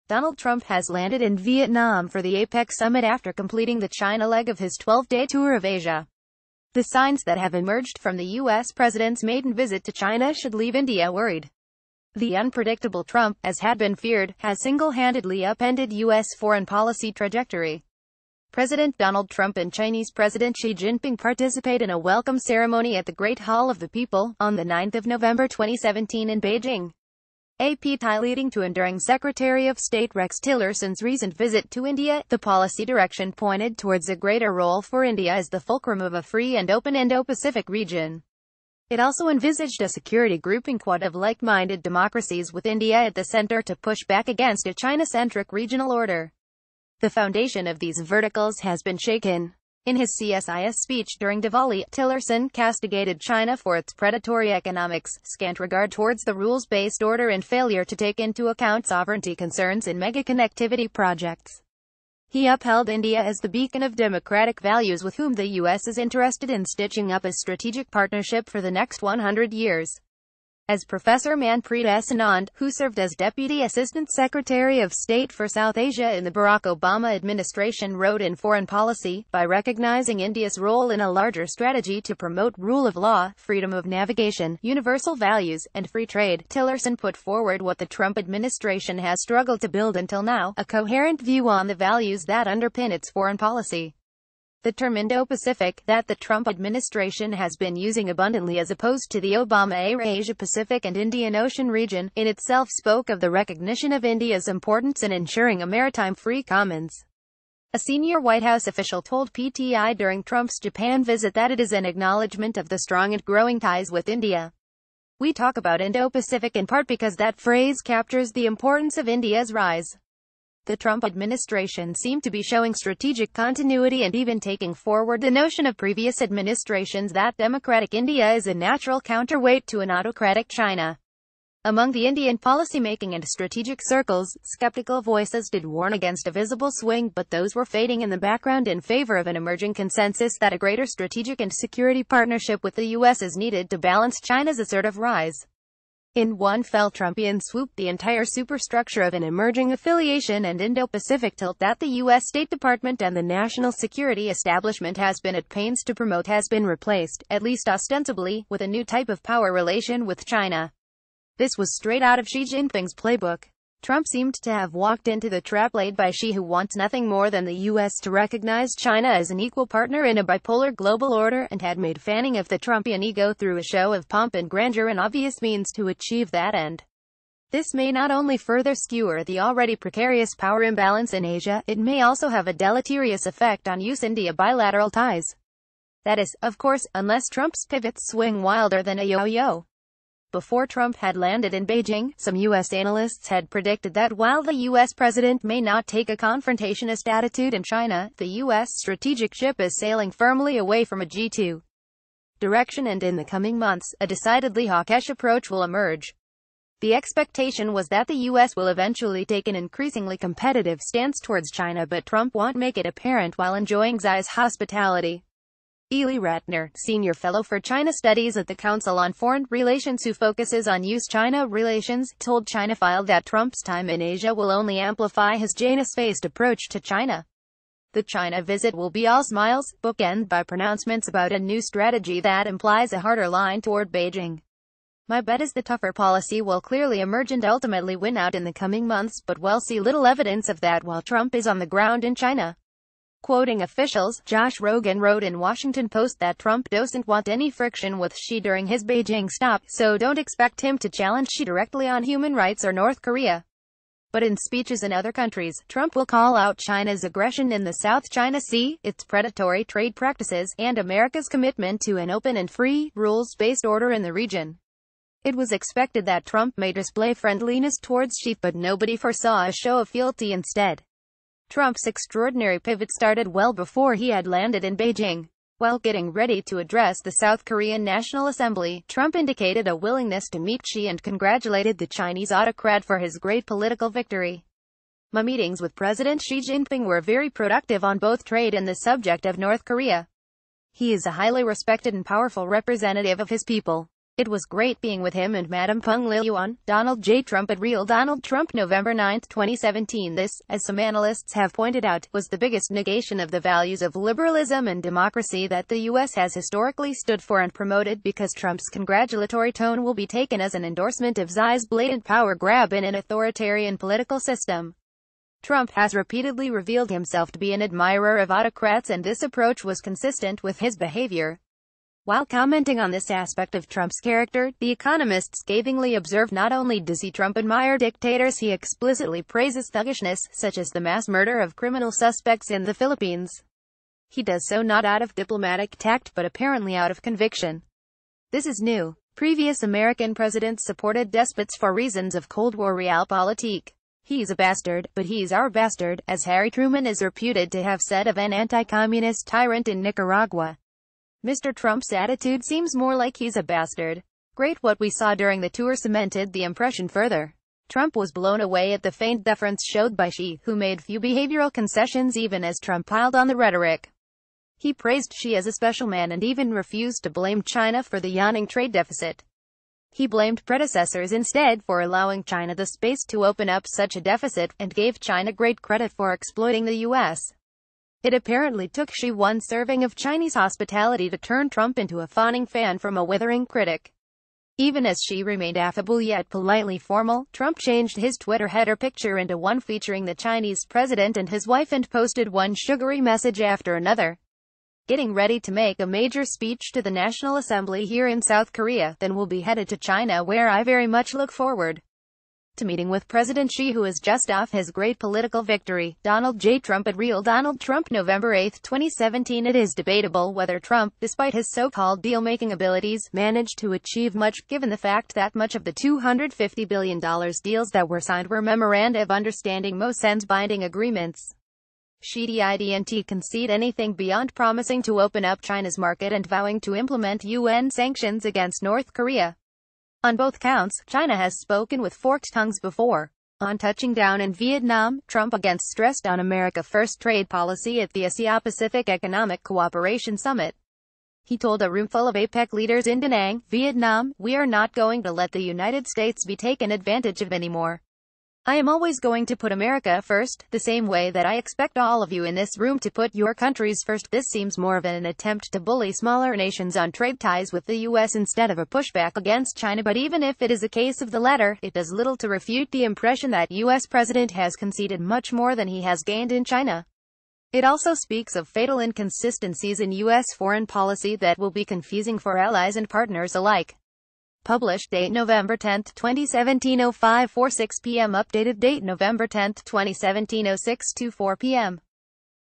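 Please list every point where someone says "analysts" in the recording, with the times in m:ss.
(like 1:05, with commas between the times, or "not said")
3:12, 5:00.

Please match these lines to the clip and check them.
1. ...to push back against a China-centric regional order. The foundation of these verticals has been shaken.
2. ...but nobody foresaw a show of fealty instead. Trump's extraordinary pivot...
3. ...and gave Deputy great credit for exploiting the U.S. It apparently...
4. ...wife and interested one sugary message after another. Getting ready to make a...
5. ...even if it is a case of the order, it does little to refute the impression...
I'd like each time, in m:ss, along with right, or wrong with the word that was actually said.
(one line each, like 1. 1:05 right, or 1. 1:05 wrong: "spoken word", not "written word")
1. 0:43 right
2. 4:28 right
3. 6:14 wrong: "China", not "Deputy"
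4. 6:31 wrong: "posted", not "interested"
5. 7:39 wrong: "latter", not "order".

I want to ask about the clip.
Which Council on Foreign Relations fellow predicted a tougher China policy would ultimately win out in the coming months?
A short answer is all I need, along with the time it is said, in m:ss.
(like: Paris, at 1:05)
Ely Ratner, at 3:35.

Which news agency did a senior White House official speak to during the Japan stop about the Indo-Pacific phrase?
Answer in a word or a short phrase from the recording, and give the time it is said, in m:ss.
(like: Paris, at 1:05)
PTI, at 1:49.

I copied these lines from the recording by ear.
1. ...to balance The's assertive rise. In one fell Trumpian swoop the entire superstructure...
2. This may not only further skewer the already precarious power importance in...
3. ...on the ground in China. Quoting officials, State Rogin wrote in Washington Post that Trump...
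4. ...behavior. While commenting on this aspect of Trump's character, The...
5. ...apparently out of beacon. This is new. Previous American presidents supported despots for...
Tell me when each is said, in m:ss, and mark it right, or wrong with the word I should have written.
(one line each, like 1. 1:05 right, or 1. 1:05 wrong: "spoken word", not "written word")
1. 2:23 wrong: "China", not "The"
2. 2:57 wrong: "imbalance", not "importance"
3. 4:01 wrong: "Josh", not "State"
4. 5:20 right
5. 5:36 wrong: "conviction", not "beacon".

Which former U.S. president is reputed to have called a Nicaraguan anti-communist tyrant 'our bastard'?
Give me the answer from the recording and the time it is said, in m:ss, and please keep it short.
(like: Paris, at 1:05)
Harry Truman, at 5:46.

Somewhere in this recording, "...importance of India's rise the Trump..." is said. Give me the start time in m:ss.
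1:58.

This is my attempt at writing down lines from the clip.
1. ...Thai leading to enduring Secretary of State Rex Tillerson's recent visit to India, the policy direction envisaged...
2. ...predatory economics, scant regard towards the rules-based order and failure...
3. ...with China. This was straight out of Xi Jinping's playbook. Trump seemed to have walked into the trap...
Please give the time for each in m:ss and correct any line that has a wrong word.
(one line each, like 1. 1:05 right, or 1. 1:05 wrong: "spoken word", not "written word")
1. 0:27 wrong: "pointed", not "envisaged"
2. 0:53 right
3. 2:40 right.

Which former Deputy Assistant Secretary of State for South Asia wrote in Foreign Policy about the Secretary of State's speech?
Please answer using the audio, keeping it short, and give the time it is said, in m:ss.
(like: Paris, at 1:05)
Manpreet S. Anand, at 1:11.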